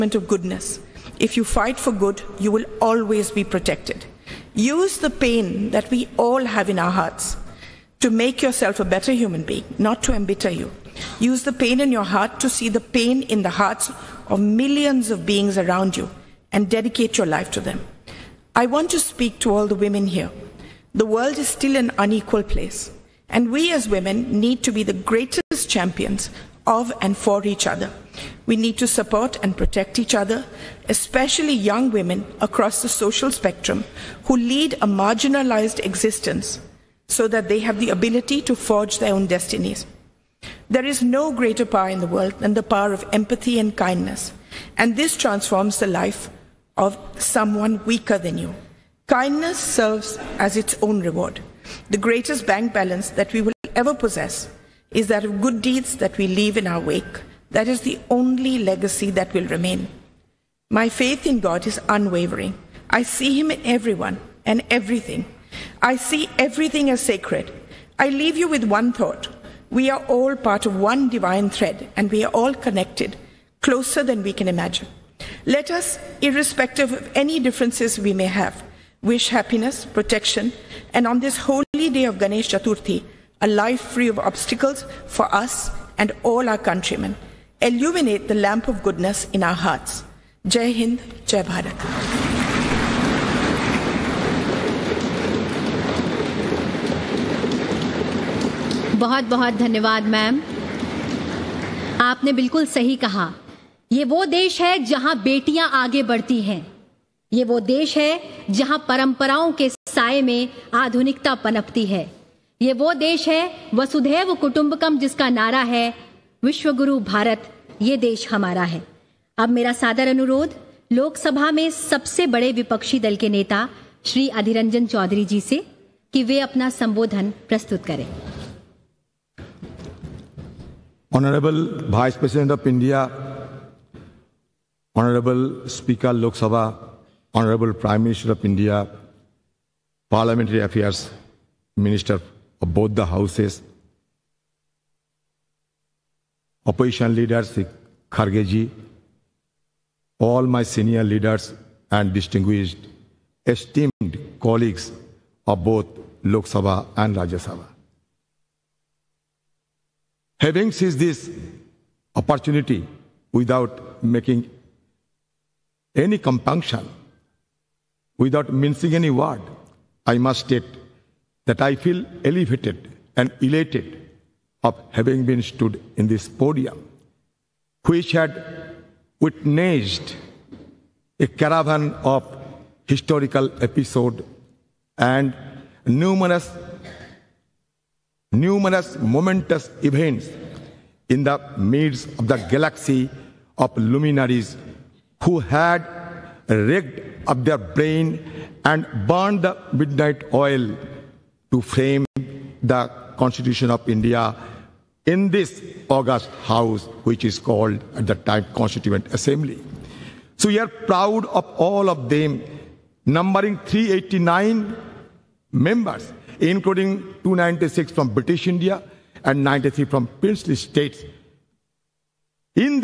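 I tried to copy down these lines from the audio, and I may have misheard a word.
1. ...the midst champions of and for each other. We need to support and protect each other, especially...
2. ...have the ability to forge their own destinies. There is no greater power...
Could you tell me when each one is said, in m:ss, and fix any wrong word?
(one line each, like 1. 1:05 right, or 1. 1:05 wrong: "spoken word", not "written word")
1. 0:24 wrong: "greatest", not "midst"
2. 0:37 right.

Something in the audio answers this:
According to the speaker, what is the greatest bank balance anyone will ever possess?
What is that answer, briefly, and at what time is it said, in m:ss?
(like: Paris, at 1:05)
Good deeds, at 0:55.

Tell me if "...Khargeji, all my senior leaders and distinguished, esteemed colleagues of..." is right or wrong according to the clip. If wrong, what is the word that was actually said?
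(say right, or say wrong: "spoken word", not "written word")
right.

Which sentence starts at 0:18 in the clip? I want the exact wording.
I want to speak to all the women here.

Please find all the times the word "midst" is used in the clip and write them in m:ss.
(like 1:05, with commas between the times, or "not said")
3:11.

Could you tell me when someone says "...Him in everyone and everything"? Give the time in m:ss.
1:03.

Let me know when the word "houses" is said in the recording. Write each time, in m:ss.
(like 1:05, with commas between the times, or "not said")
2:23, 3:26.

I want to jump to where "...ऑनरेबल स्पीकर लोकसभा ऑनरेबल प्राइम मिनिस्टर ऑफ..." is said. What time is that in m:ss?
2:15.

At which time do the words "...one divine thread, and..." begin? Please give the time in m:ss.
1:10.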